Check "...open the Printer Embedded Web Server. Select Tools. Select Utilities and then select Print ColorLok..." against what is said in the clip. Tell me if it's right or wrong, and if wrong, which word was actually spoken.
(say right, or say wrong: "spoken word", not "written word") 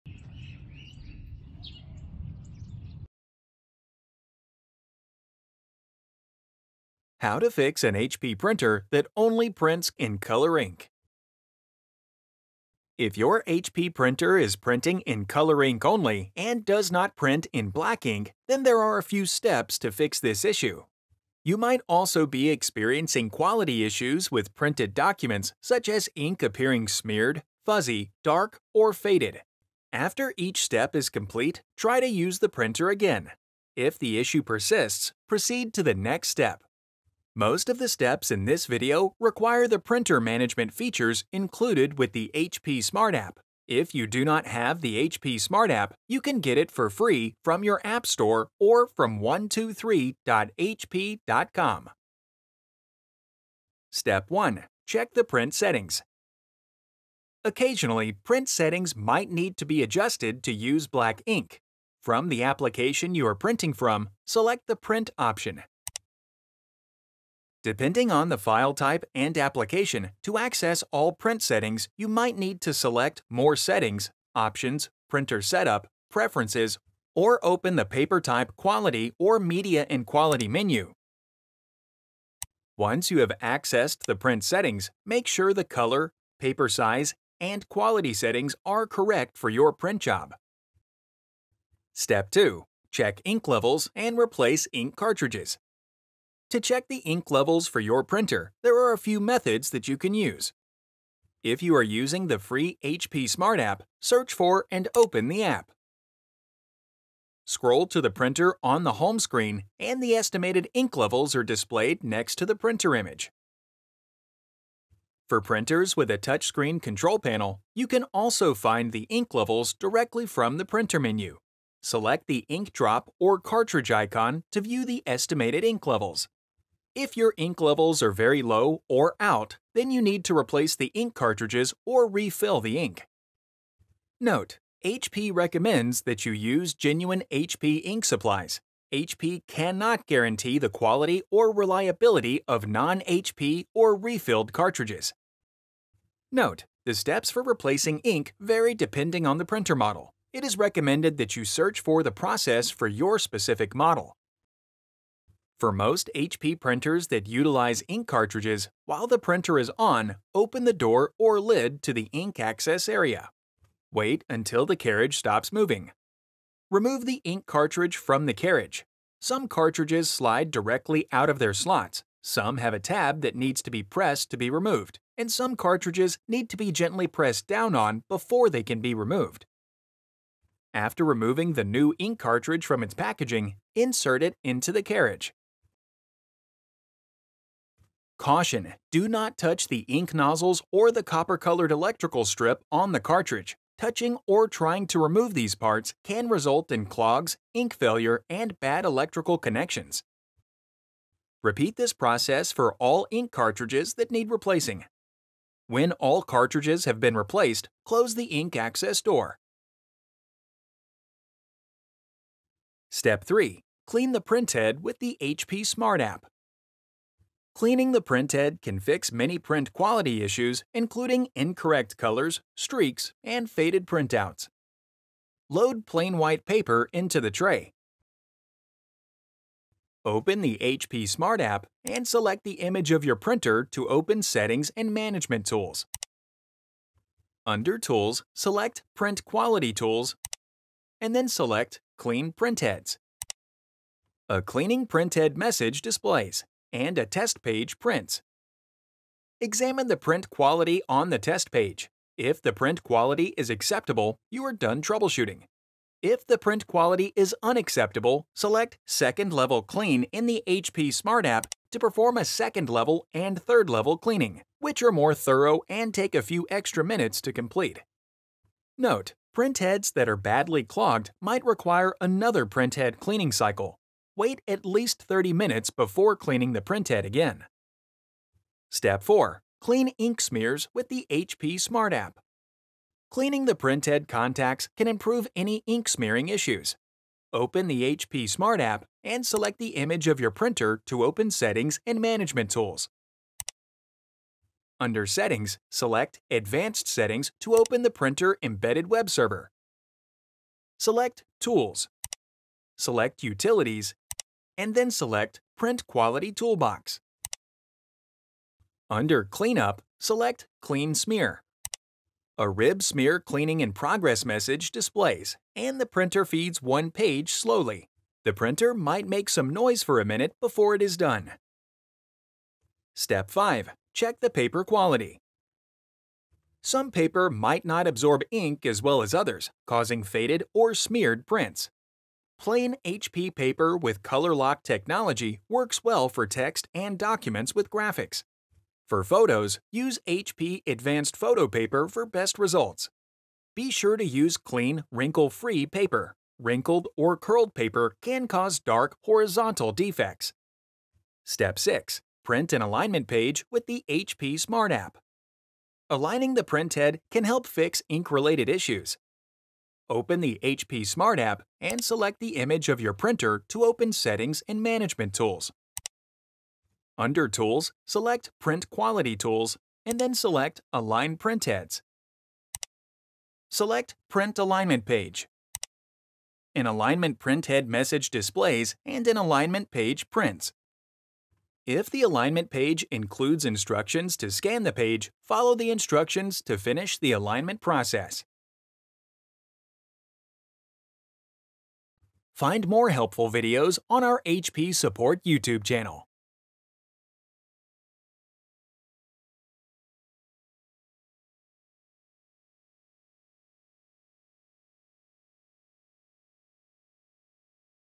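wrong: "Quality", not "ColorLok".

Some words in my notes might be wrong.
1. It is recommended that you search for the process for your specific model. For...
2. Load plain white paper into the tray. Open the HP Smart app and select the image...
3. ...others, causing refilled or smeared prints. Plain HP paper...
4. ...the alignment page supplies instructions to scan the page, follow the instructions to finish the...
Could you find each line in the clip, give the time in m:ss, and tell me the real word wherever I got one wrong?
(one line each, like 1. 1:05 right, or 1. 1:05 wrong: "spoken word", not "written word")
1. 2:30 right
2. 3:45 right
3. 5:29 wrong: "faded", not "refilled"
4. 6:21 wrong: "includes", not "supplies".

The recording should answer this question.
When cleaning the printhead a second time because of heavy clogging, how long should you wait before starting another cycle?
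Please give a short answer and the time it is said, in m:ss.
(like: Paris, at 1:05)
30 minutes, at 4:35.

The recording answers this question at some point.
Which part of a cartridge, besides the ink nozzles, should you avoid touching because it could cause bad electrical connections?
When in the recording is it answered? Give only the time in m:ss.
3:11.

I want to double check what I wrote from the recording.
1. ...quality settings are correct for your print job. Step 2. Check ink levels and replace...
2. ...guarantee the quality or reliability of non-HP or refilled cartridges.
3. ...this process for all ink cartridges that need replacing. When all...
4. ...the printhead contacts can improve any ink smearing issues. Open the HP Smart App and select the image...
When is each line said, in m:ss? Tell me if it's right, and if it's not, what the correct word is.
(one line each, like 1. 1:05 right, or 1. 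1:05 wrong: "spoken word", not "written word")
1. 1:27 right
2. 2:20 right
3. 3:21 right
4. 4:43 right.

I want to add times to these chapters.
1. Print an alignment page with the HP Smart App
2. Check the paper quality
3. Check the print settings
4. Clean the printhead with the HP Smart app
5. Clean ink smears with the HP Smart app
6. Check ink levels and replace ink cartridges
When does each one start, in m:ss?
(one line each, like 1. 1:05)
1. 5:50
2. 5:22
3. 0:54
4. 3:33
5. 4:38
6. 1:31.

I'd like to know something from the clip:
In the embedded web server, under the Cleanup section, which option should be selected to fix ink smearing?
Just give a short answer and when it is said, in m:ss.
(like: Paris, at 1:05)
Clean Smear, at 5:10.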